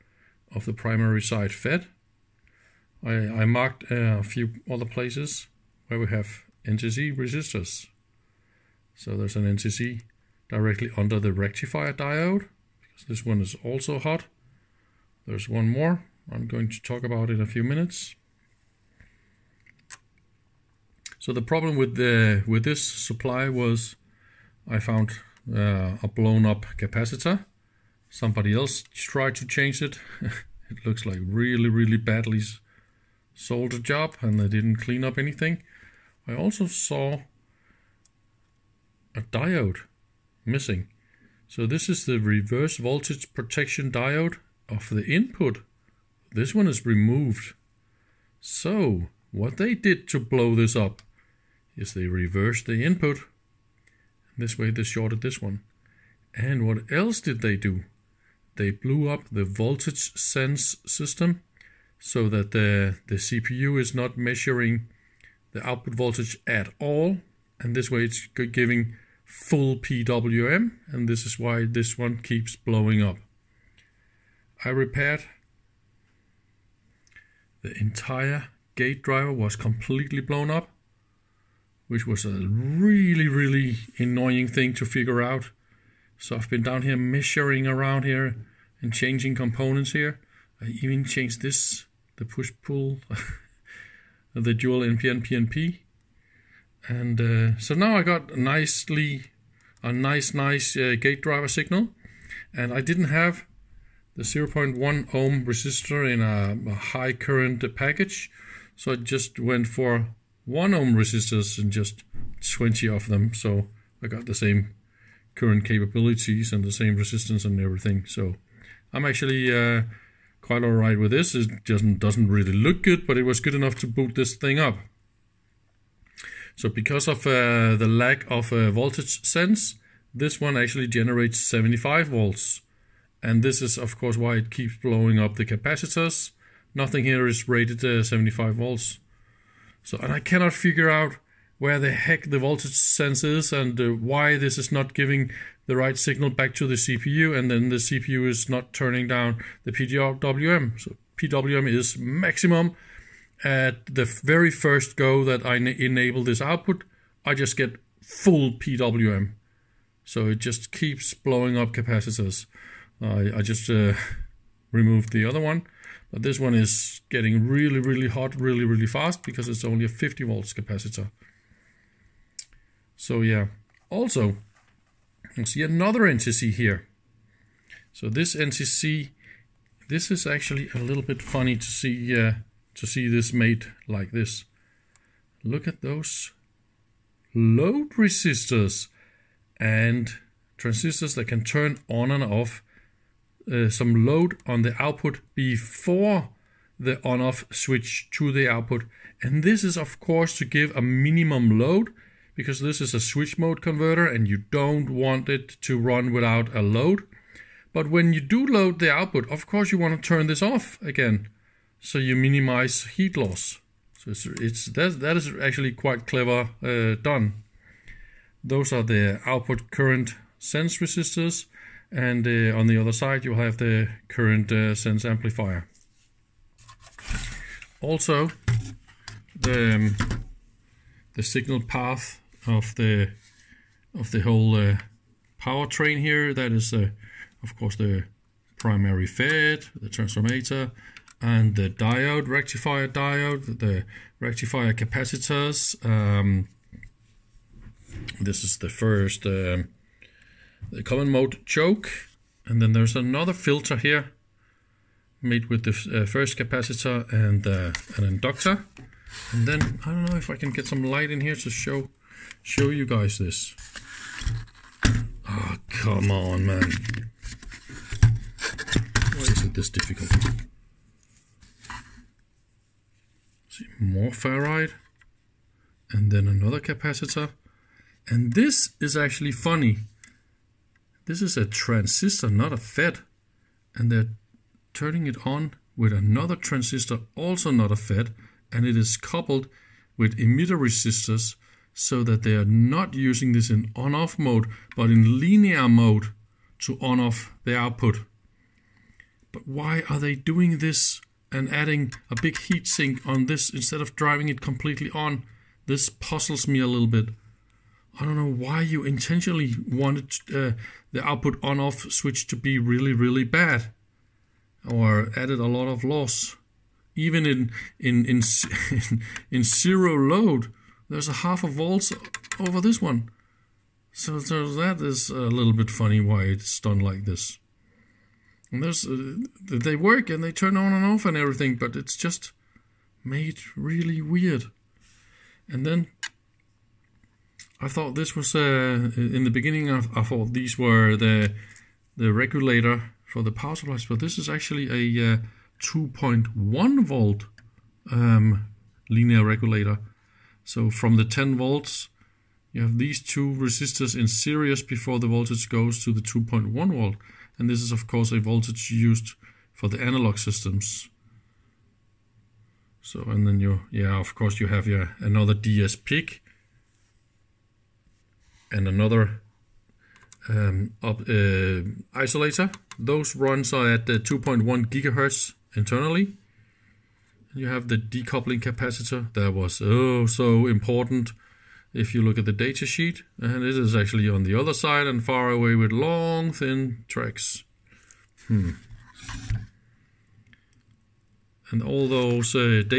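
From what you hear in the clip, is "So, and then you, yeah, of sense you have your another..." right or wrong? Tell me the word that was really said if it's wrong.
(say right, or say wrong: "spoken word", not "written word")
wrong: "course", not "sense".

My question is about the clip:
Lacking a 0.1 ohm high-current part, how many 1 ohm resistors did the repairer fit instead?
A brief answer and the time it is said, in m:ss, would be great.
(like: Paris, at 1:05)
20, at 1:52.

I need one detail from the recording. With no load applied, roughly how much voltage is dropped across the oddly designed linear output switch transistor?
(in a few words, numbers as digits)
Half a volt.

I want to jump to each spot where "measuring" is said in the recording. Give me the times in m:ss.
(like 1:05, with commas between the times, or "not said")
1:04, 1:26.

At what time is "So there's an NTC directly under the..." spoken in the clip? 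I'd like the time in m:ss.
0:08.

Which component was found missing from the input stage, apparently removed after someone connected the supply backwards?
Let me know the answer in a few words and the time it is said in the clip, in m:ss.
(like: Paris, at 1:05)
Reverse voltage protection diode, at 0:42.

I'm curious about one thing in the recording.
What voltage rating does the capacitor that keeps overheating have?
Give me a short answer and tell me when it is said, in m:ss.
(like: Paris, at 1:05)
50 volts, at 2:49.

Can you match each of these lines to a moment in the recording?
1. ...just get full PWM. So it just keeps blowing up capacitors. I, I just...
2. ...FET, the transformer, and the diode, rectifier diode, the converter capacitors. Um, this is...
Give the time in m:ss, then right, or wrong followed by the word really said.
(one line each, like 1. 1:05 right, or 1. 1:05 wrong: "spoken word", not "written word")
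1. 2:37 right
2. 3:59 wrong: "rectifier", not "converter".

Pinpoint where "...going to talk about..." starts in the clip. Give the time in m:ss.
0:16.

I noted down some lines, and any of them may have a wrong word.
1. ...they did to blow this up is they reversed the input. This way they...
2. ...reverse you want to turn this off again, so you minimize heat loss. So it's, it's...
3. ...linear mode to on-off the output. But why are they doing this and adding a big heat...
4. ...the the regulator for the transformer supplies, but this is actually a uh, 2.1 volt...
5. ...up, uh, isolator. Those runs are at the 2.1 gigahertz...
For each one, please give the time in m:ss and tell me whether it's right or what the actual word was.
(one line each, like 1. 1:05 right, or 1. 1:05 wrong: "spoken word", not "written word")
1. 0:49 right
2. 3:29 wrong: "course", not "reverse"
3. 4:55 right
4. 5:40 wrong: "power", not "transformer"
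5. 6:10 right.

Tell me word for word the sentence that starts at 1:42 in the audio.
And I didn't have the 0.1 ohm resistor in a, a high current package.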